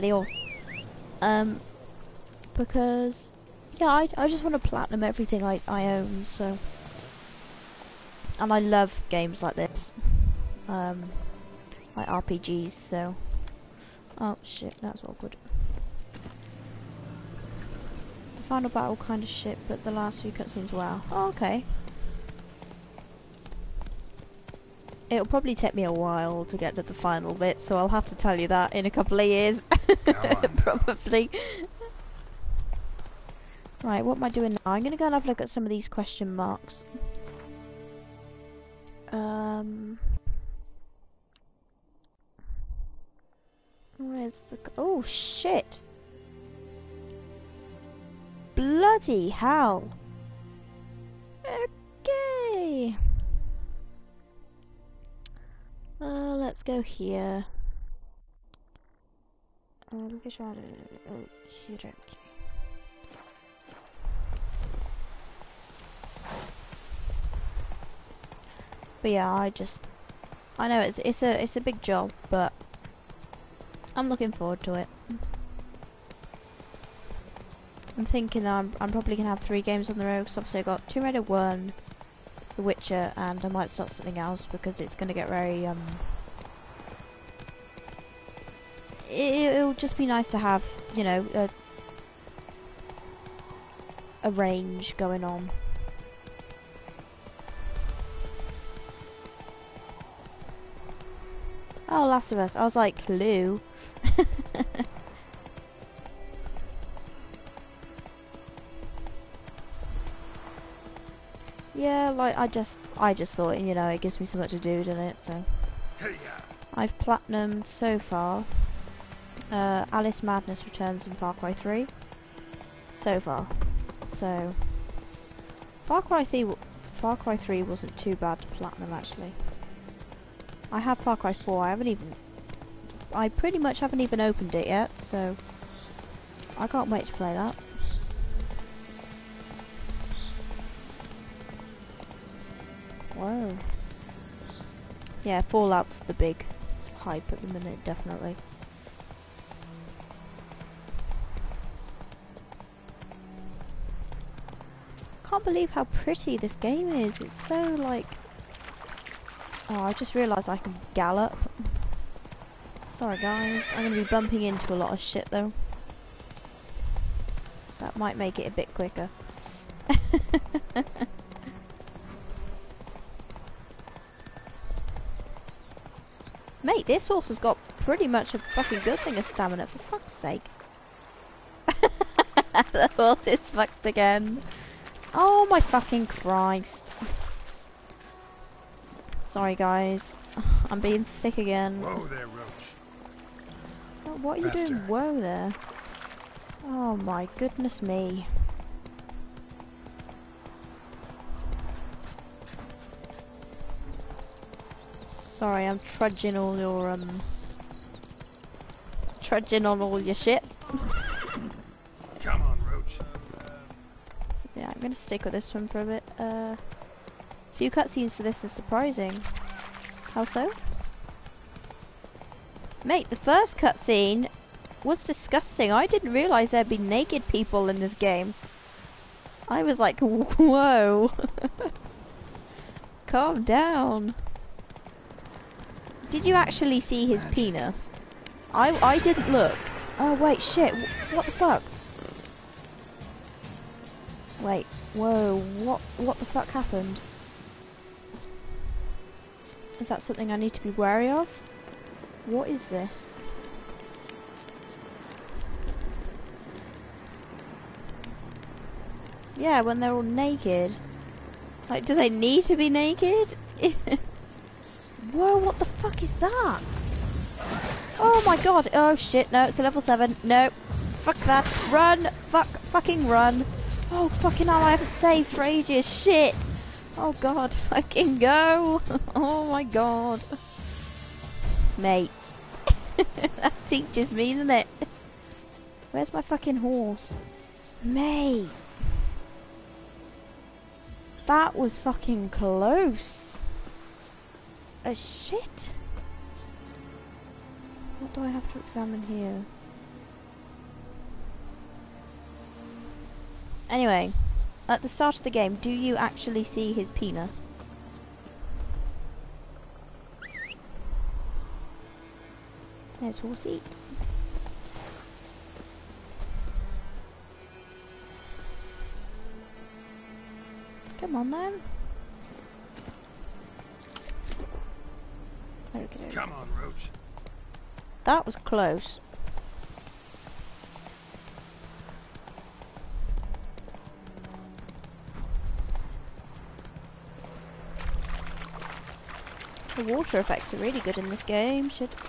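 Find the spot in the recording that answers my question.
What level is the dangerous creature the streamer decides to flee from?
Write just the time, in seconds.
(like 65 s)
269 s.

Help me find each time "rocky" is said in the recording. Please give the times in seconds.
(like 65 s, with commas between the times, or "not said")
not said.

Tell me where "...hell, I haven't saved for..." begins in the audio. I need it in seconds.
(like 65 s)
274 s.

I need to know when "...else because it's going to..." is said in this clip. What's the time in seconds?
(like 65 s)
84 s.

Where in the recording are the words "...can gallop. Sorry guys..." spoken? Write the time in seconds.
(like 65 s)
160 s.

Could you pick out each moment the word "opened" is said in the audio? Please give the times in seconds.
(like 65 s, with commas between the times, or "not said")
134 s.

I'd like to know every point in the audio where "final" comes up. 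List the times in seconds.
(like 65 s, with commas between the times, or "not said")
18 s, 26 s.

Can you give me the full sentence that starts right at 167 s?
That might make it a bit quicker.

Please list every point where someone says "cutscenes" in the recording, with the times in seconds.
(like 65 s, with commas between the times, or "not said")
20 s, 217 s, 223 s.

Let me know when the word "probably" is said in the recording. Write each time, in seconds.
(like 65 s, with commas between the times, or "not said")
25 s, 30 s, 78 s.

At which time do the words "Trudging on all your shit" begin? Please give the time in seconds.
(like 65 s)
209 s.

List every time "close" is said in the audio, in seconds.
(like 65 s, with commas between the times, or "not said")
292 s, 328 s.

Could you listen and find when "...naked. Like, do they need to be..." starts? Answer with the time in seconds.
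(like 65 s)
260 s.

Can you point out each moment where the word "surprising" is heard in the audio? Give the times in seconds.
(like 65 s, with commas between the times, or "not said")
218 s.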